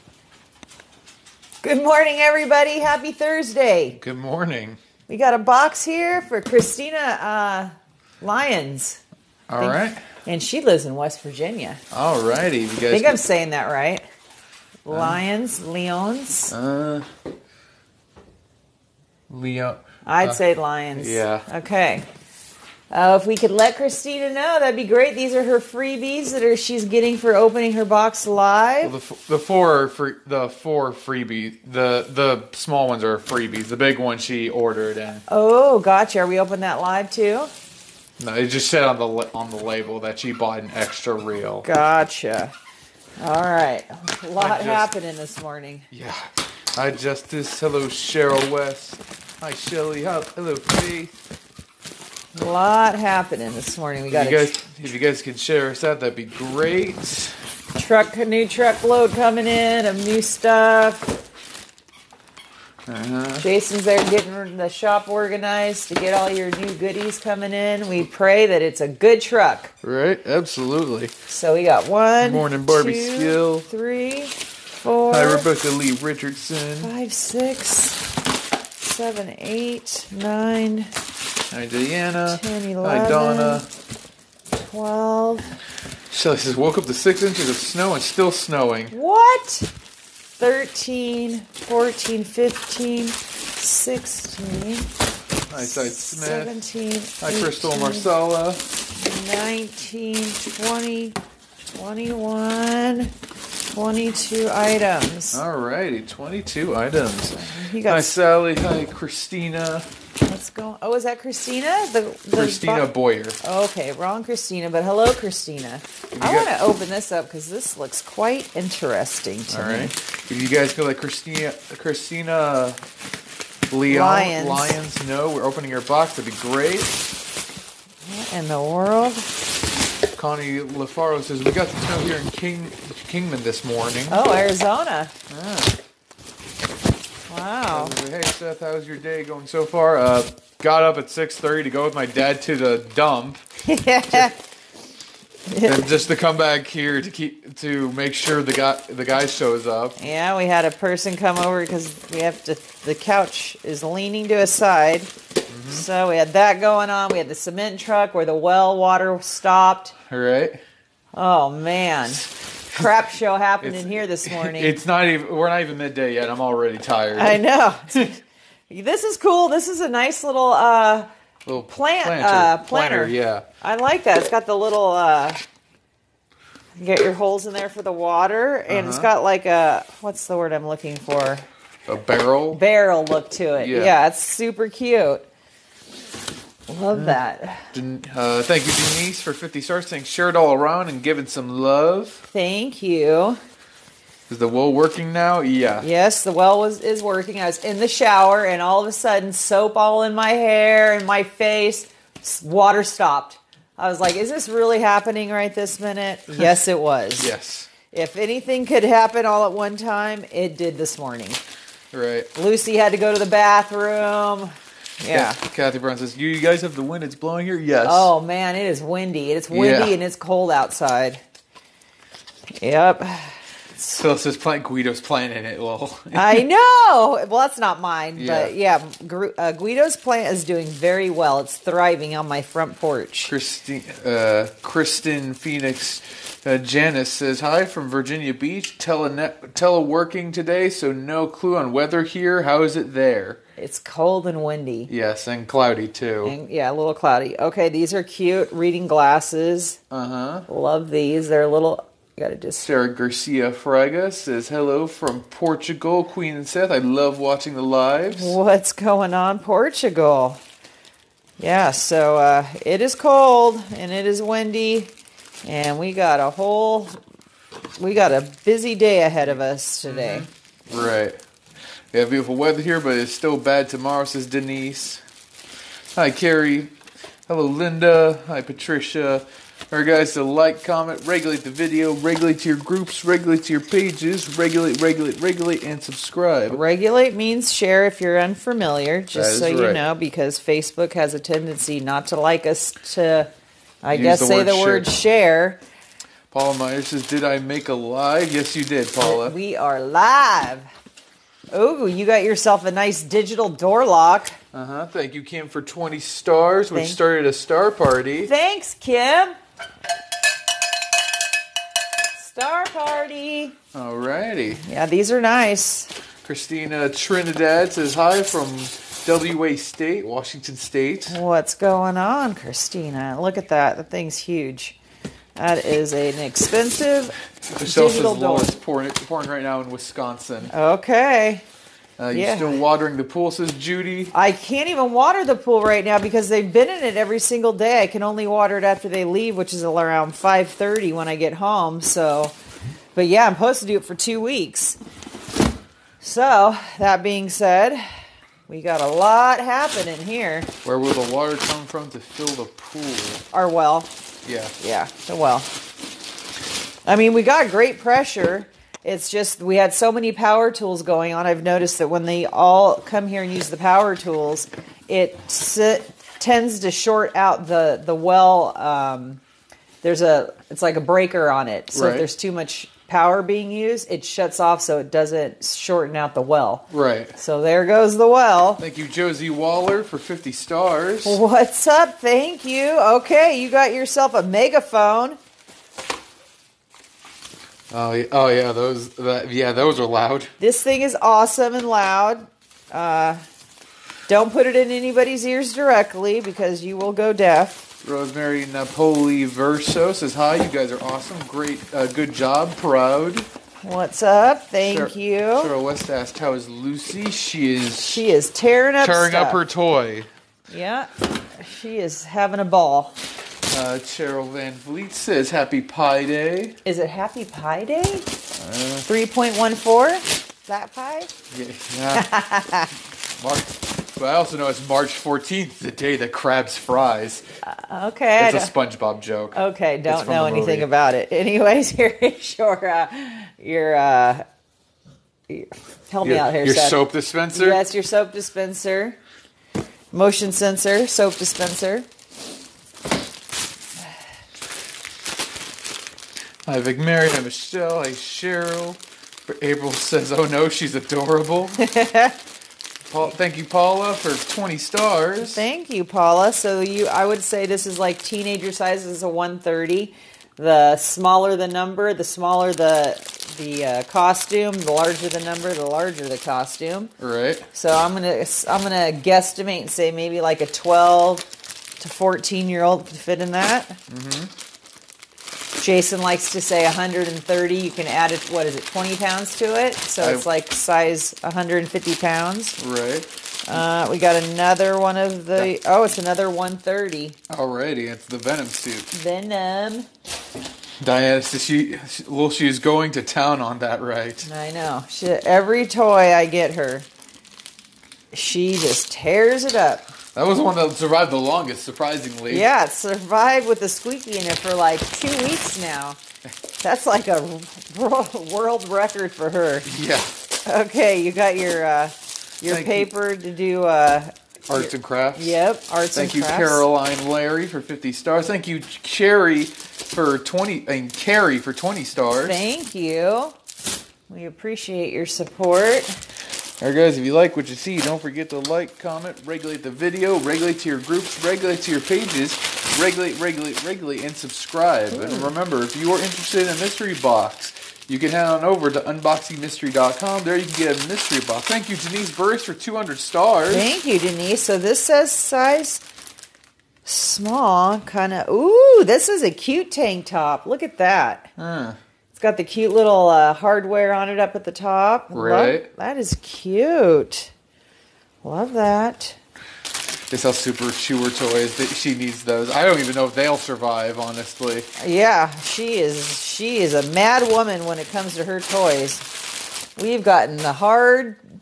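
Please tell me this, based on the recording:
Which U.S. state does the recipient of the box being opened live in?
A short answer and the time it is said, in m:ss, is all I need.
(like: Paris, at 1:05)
West Virginia, at 0:10.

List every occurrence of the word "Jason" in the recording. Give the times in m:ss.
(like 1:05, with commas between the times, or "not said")
1:03, 7:55.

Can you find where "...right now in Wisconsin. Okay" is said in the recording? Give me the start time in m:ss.
5:29.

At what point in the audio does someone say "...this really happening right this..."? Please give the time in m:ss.
3:24.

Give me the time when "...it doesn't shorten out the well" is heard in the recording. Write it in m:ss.
6:14.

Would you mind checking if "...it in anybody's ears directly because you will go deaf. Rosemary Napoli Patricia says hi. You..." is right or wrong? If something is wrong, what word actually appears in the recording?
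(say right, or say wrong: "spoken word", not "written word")
wrong: "Verso", not "Patricia".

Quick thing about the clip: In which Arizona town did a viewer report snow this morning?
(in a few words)
Kingman.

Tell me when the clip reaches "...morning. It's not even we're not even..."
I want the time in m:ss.
2:44.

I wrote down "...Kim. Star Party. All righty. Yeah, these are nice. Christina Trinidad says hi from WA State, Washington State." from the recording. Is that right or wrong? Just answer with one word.
right.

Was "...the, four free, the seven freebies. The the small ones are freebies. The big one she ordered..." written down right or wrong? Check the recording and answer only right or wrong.
wrong.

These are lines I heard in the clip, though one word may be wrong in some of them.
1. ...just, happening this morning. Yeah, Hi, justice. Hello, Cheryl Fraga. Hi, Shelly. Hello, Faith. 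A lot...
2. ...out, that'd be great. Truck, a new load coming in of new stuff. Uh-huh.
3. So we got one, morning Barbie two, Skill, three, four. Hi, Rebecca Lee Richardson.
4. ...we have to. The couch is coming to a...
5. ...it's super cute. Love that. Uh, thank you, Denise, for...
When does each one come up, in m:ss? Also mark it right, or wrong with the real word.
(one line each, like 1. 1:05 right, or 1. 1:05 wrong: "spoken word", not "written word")
1. 0:44 wrong: "West", not "Fraga"
2. 0:55 right
3. 1:11 right
4. 2:32 wrong: "leaning", not "coming"
5. 3:04 right.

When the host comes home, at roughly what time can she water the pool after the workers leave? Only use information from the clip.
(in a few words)
5:30.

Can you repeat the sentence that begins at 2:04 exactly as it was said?
Lions, no, we're opening your box.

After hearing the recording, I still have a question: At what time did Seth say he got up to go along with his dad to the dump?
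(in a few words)
6:30.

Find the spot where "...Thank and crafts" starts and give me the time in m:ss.
8:35.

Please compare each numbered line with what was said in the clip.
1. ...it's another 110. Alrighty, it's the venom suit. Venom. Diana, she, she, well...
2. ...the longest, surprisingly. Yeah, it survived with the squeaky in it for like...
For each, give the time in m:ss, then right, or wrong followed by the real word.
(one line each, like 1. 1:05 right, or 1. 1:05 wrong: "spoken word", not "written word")
1. 8:05 wrong: "130", not "110"
2. 8:21 right.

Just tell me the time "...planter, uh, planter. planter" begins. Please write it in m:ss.
2:52.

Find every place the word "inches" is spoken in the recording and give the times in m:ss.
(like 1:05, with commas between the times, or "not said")
1:27.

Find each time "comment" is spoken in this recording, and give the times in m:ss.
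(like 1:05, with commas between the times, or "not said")
4:40, 8:48.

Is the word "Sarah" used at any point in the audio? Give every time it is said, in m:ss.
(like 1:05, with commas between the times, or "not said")
4:12, 6:44.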